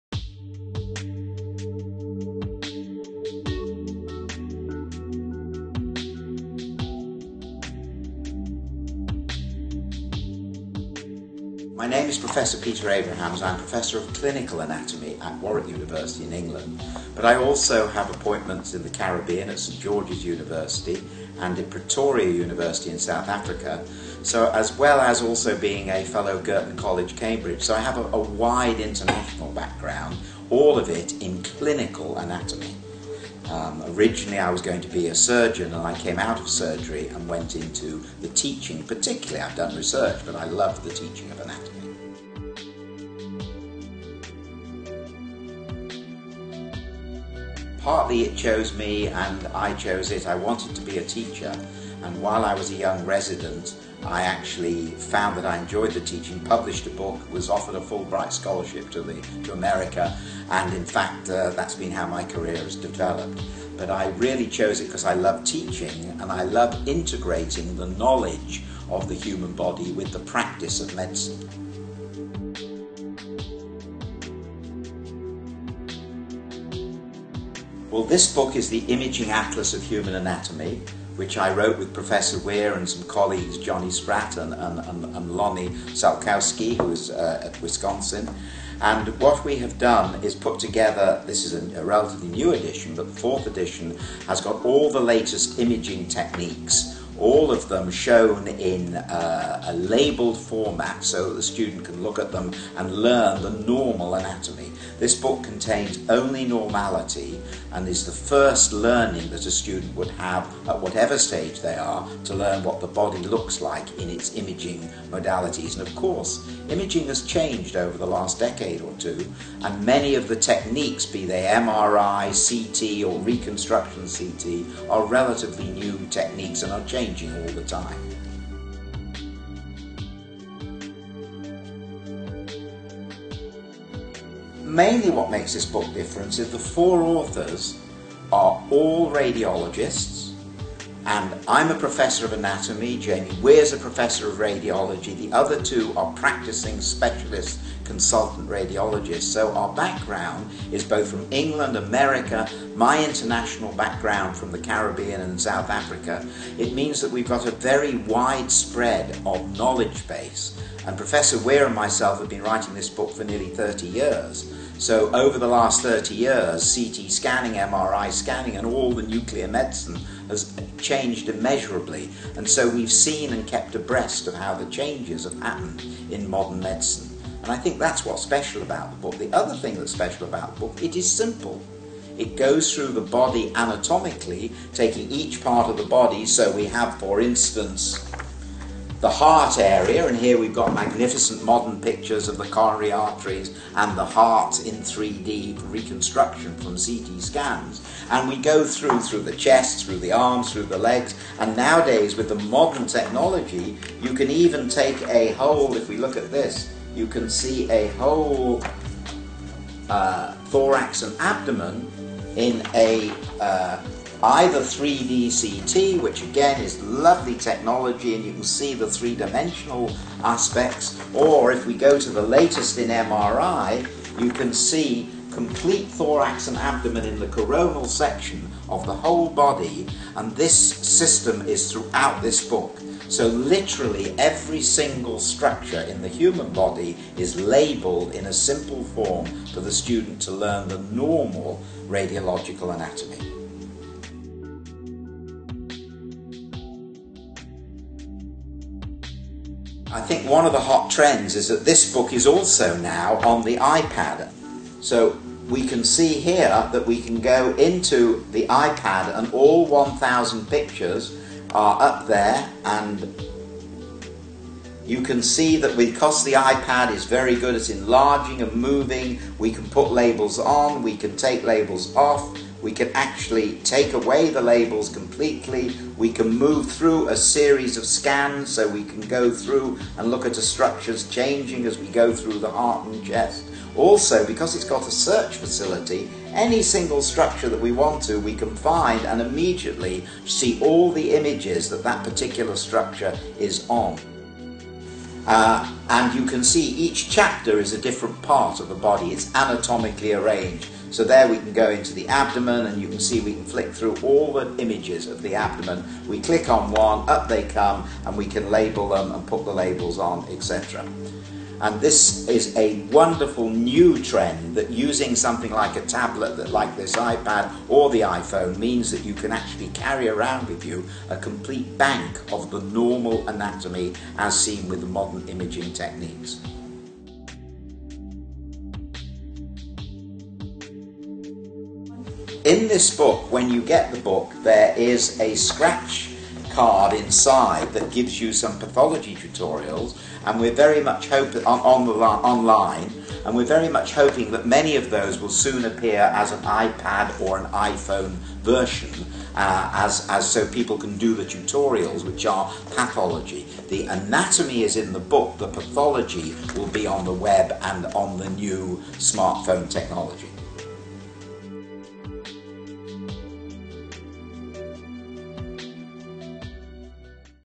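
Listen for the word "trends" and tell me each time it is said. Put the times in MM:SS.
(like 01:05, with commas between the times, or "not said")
04:10, 05:14.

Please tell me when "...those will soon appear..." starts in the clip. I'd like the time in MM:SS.
05:44.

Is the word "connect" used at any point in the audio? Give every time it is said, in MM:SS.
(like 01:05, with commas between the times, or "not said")
not said.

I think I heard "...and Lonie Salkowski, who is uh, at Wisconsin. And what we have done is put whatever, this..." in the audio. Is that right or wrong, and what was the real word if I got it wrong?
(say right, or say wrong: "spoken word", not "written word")
wrong: "together", not "whatever".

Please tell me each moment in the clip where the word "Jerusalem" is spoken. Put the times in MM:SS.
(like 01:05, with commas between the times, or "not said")
not said.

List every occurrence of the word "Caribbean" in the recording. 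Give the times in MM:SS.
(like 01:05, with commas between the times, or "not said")
00:18, 02:34.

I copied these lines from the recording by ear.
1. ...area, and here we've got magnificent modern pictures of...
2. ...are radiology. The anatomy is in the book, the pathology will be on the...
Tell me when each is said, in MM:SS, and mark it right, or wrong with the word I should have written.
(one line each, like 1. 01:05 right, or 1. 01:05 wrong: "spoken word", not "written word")
1. 03:09 right
2. 05:52 wrong: "pathology", not "radiology".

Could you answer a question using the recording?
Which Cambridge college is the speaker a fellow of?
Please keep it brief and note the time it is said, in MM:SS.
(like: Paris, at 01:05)
Girton College, at 00:26.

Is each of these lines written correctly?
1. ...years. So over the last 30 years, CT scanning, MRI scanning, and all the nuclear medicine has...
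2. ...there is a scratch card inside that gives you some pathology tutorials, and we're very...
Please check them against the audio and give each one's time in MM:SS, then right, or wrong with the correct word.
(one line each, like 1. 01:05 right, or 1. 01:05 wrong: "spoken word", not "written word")
1. 02:43 right
2. 05:34 right.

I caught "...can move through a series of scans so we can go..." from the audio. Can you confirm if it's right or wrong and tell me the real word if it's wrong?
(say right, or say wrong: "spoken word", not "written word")
right.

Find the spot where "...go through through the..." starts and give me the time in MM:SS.
03:18.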